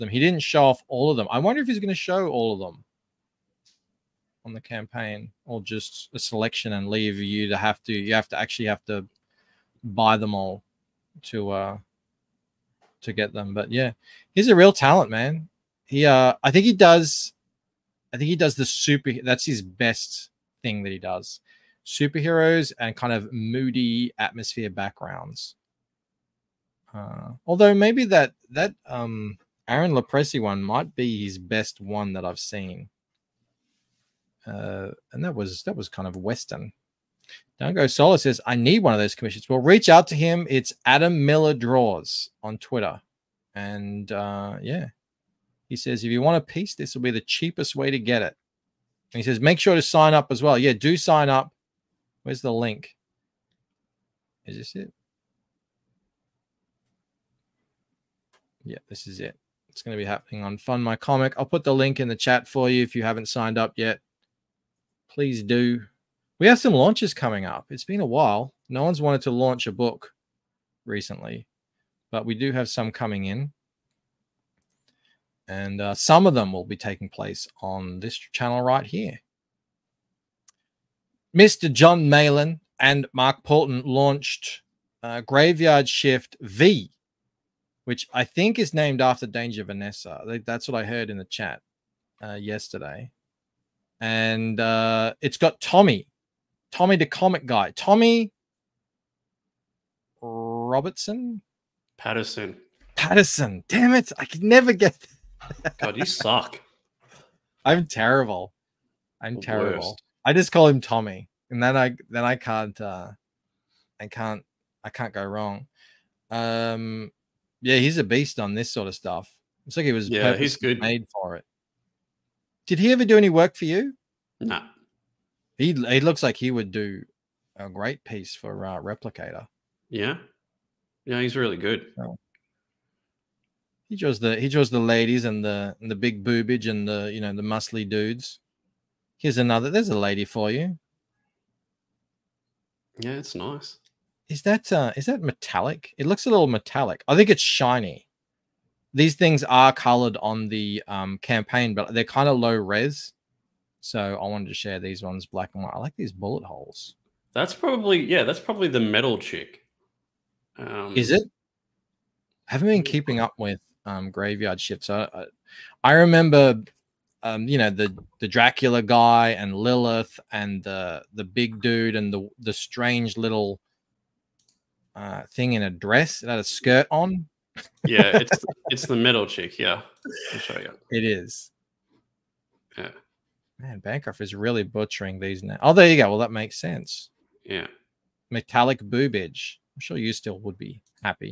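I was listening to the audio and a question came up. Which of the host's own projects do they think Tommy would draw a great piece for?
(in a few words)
Replicator.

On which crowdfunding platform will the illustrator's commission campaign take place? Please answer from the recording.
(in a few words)
Fund My Comic.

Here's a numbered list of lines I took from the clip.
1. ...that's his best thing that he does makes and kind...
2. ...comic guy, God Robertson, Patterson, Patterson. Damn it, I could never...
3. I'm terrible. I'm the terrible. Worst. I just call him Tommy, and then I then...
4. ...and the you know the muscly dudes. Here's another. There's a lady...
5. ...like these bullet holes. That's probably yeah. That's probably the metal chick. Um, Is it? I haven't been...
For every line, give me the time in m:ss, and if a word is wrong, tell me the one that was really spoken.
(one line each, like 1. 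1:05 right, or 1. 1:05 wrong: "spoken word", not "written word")
1. 0:19 wrong: "superheroes", not "makes"
2. 1:37 wrong: "Tommy", not "God"
3. 1:47 right
4. 2:16 right
5. 2:35 right.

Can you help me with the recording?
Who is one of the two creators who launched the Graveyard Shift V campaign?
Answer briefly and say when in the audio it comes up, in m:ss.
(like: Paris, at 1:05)
John Malin, at 1:21.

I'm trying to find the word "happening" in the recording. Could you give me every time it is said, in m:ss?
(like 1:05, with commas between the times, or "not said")
1:00.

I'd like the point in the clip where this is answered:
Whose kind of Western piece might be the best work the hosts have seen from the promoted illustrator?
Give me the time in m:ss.
0:29.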